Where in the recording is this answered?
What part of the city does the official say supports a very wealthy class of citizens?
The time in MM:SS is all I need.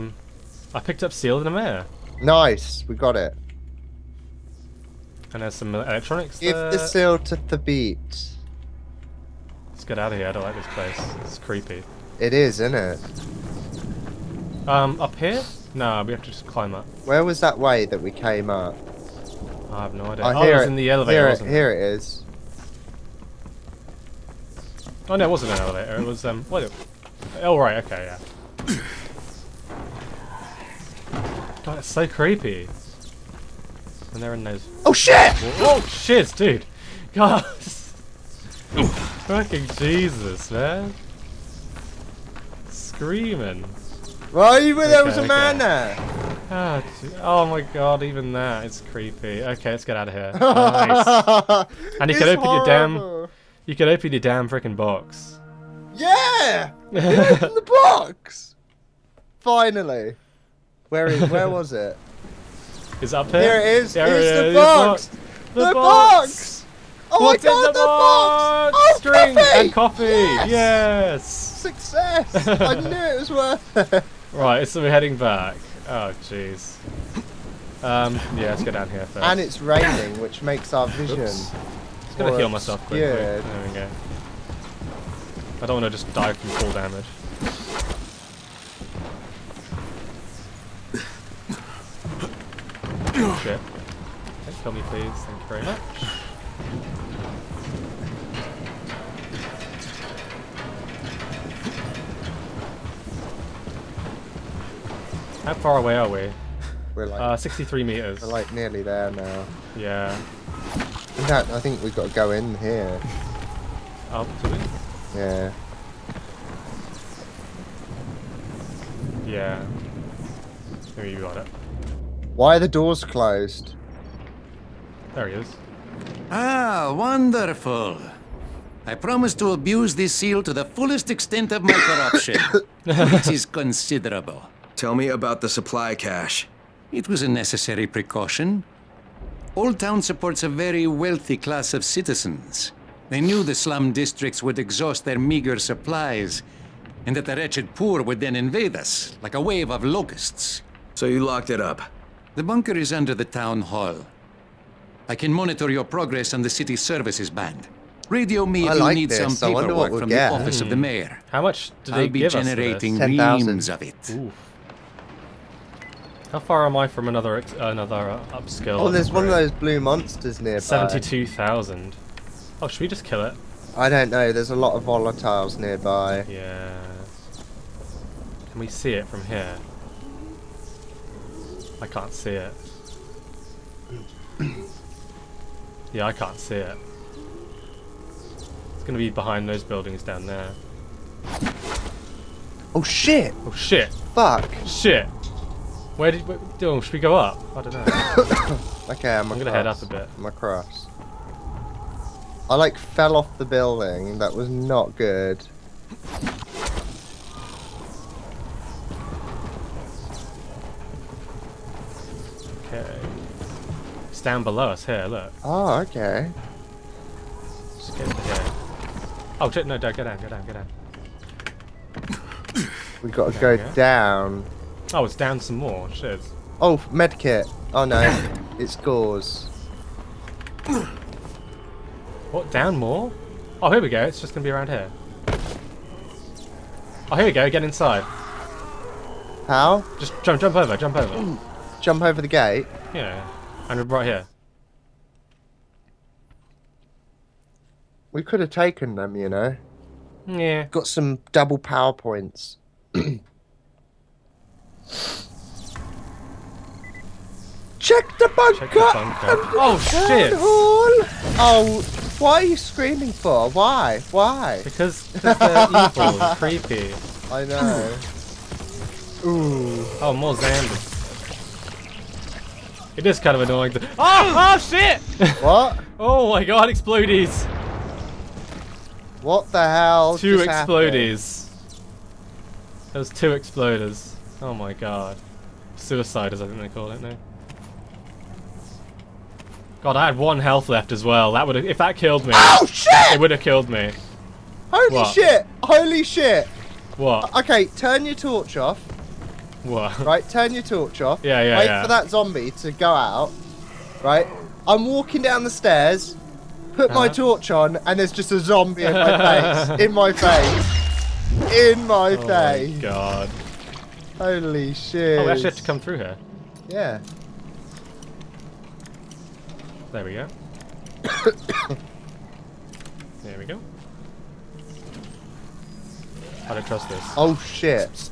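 02:19.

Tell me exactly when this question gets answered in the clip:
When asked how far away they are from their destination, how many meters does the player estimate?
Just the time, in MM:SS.
01:47.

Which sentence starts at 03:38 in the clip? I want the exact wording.
Uh, oh, no, don't, go down, go down, go down.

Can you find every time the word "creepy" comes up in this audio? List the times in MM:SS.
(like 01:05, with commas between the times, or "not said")
00:11, 00:32, 00:48, 04:26.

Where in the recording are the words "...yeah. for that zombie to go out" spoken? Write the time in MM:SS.
05:01.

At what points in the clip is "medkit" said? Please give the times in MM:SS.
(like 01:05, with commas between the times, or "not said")
03:46.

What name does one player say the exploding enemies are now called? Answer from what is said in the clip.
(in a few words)
Suiciders.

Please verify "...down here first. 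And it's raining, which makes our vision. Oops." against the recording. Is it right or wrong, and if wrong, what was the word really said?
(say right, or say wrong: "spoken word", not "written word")
right.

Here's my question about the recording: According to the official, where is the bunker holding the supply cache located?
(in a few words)
Under the town hall.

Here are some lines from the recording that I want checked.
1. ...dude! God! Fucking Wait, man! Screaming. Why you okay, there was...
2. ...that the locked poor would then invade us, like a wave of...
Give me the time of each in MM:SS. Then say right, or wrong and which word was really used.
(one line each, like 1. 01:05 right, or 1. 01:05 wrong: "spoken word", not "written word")
1. 00:36 wrong: "Jesus", not "Wait"
2. 02:27 wrong: "wretched", not "locked".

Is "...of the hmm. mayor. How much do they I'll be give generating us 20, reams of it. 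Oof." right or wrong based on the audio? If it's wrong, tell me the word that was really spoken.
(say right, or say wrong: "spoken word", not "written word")
wrong: "10", not "20".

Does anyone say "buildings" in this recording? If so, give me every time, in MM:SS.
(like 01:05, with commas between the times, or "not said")
03:09, 03:23.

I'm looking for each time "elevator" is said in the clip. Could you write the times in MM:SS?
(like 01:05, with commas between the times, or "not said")
00:20, 00:25.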